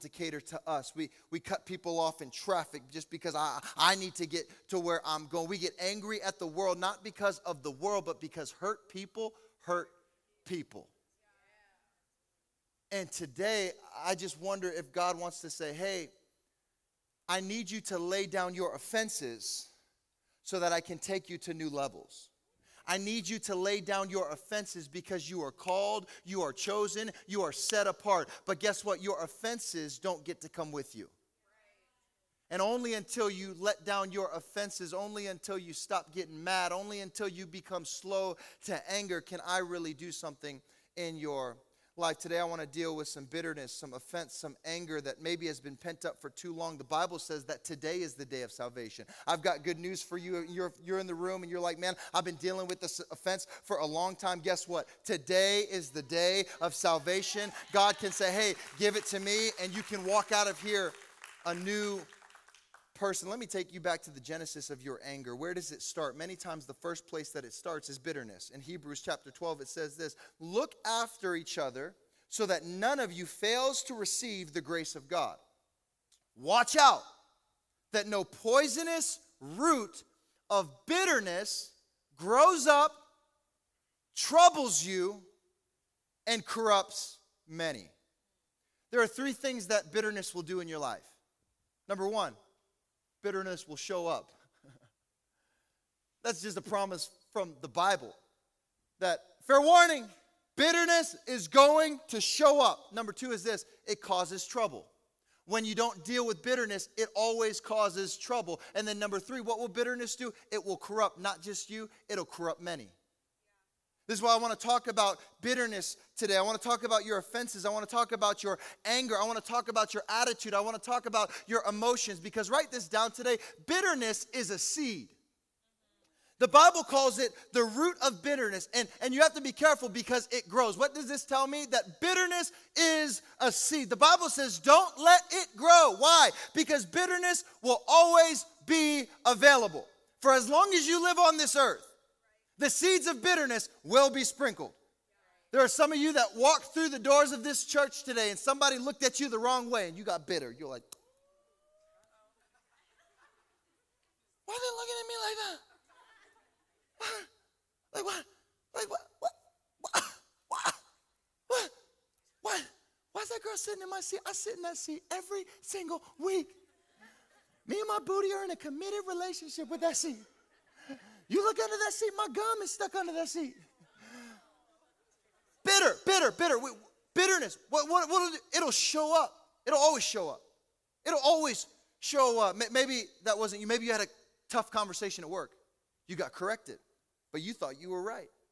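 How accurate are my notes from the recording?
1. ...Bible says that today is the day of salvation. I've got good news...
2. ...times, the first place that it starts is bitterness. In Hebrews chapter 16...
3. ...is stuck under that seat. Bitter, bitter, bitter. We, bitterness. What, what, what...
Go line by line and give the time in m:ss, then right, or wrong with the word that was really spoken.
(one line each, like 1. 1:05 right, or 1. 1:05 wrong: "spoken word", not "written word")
1. 0:46 right
2. 1:06 wrong: "12", not "16"
3. 2:52 right.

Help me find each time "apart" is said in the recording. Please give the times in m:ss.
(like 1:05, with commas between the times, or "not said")
0:27.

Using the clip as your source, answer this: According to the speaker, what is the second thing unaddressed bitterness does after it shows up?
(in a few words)
It causes trouble.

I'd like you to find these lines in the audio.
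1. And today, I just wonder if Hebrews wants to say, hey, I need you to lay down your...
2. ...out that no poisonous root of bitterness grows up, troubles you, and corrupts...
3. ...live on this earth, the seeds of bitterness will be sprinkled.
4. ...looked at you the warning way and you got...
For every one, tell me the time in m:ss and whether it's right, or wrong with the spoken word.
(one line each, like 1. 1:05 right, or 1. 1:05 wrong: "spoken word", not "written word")
1. 0:12 wrong: "God", not "Hebrews"
2. 1:16 right
3. 2:21 right
4. 2:28 wrong: "wrong", not "warning".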